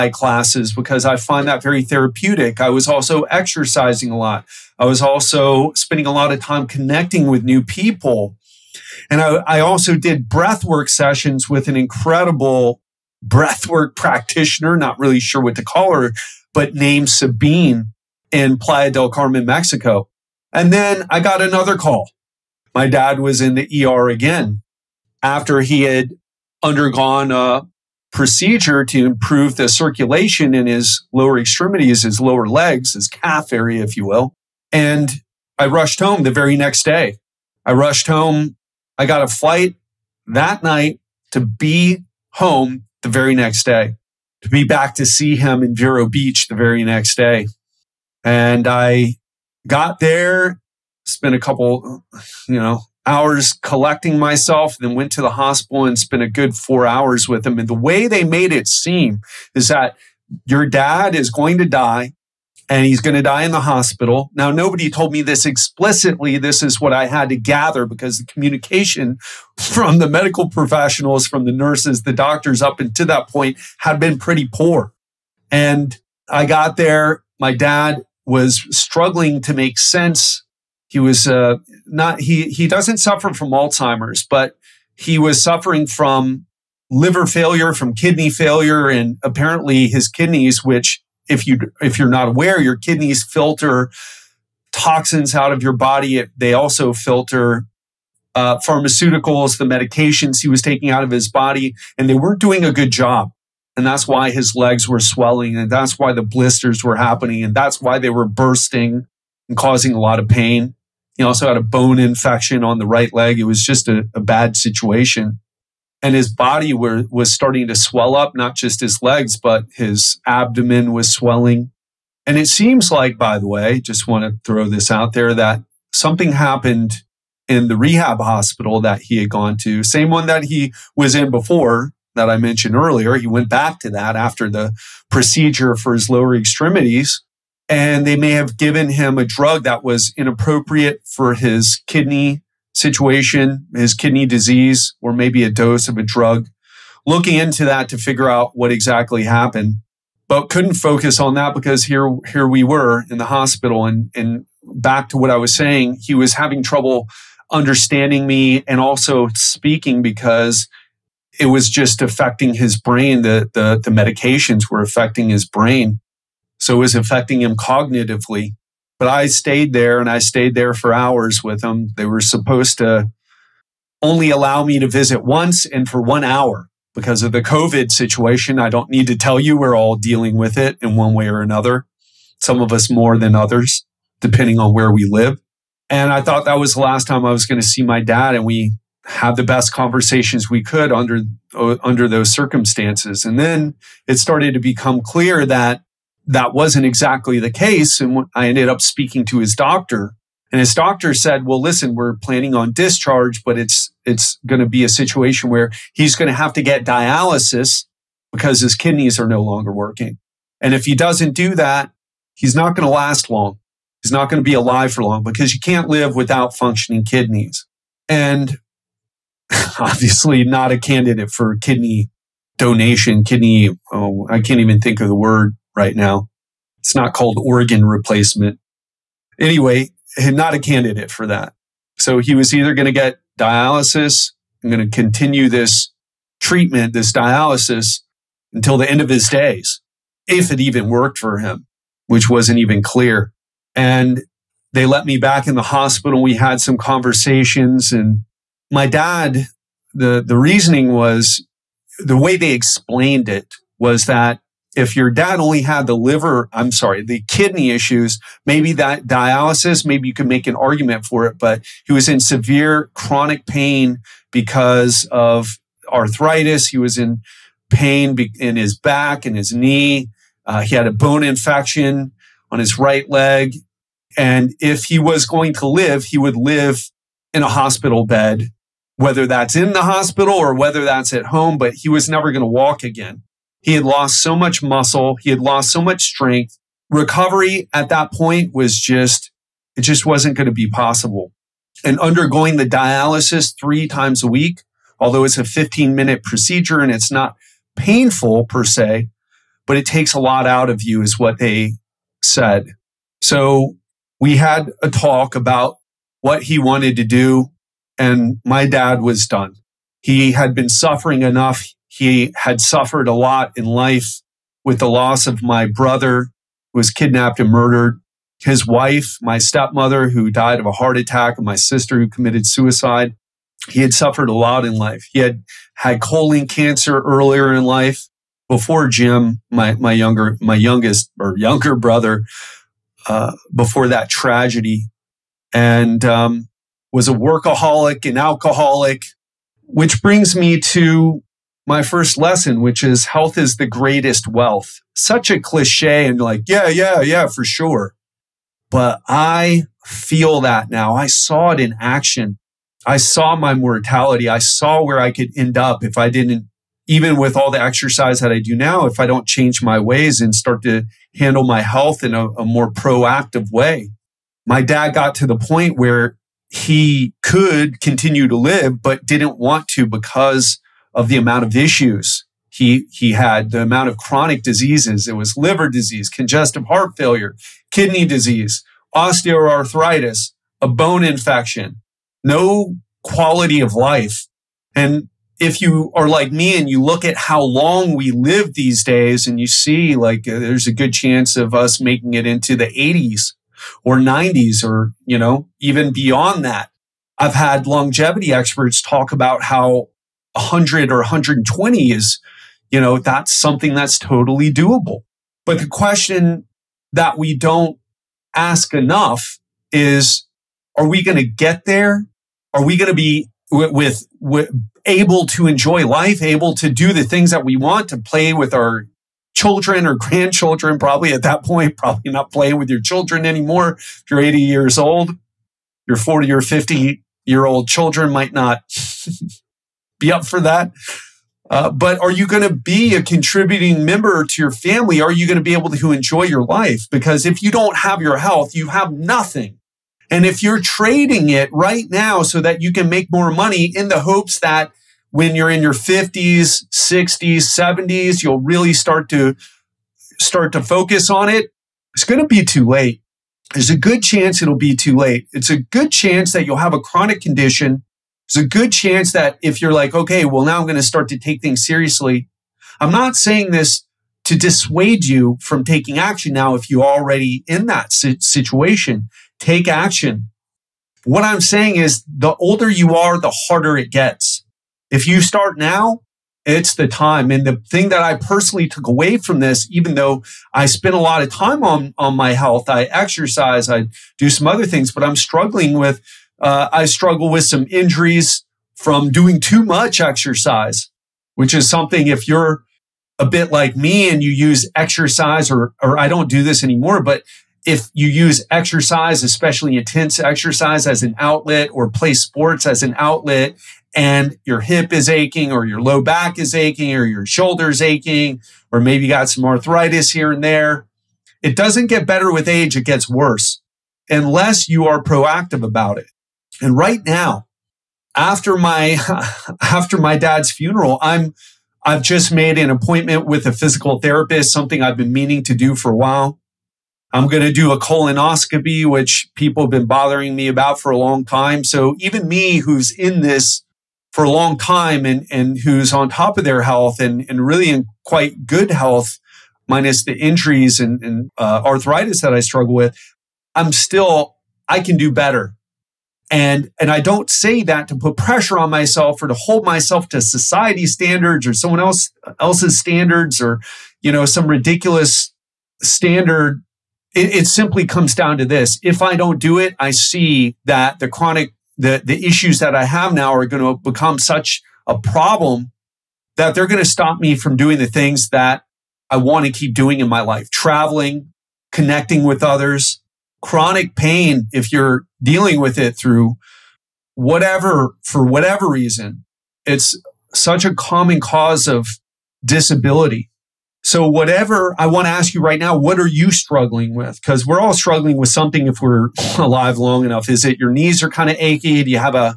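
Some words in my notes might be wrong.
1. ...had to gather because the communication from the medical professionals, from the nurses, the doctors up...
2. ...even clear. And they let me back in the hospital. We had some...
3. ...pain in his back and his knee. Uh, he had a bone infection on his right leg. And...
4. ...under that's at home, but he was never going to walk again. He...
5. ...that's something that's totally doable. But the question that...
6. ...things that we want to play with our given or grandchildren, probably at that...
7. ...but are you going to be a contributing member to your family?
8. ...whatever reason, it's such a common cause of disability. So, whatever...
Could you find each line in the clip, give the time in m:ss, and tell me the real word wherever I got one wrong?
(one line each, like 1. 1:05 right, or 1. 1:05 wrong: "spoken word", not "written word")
1. 1:07 right
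2. 4:02 right
3. 4:27 right
4. 4:40 wrong: "whether", not "under"
5. 6:42 right
6. 6:57 wrong: "children", not "given"
7. 7:11 right
8. 9:38 right.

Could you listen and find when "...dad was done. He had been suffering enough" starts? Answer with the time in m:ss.
5:08.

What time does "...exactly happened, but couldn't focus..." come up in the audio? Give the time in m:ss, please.
2:28.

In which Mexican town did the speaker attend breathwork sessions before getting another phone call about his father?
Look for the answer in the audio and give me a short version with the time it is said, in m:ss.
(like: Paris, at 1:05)
Playa del Carmen, at 0:18.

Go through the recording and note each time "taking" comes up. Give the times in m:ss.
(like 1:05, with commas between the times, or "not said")
1:40, 7:45.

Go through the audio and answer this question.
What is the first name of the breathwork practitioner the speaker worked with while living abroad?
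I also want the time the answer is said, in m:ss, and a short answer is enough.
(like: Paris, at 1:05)
Sabine, at 0:17.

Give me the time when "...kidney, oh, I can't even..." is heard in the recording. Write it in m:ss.
3:43.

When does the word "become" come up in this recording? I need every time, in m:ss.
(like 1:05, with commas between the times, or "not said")
3:14, 9:23.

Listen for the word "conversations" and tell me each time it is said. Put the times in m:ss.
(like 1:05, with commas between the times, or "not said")
3:09, 4:06.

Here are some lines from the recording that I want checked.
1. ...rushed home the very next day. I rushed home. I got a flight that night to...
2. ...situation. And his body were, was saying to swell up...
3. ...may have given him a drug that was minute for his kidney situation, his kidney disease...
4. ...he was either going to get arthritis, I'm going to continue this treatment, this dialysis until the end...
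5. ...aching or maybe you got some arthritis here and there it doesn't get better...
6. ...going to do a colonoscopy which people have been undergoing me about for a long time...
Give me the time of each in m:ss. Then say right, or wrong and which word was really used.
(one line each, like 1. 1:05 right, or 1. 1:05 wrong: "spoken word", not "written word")
1. 0:35 right
2. 1:54 wrong: "starting", not "saying"
3. 2:18 wrong: "inappropriate", not "minute"
4. 3:52 wrong: "dialysis", not "arthritis"
5. 8:27 right
6. 8:47 wrong: "bothering", not "undergoing".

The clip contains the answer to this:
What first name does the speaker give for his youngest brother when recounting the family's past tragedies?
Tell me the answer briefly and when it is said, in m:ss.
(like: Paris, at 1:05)
Jim, at 5:28.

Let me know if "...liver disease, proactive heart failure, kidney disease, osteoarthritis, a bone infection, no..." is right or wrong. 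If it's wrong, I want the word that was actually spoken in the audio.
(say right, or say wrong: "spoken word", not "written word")
wrong: "congestive", not "proactive".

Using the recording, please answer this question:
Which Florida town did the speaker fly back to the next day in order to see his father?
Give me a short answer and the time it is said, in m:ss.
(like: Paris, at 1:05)
Vero Beach, at 0:45.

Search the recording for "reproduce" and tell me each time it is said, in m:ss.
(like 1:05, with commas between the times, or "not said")
not said.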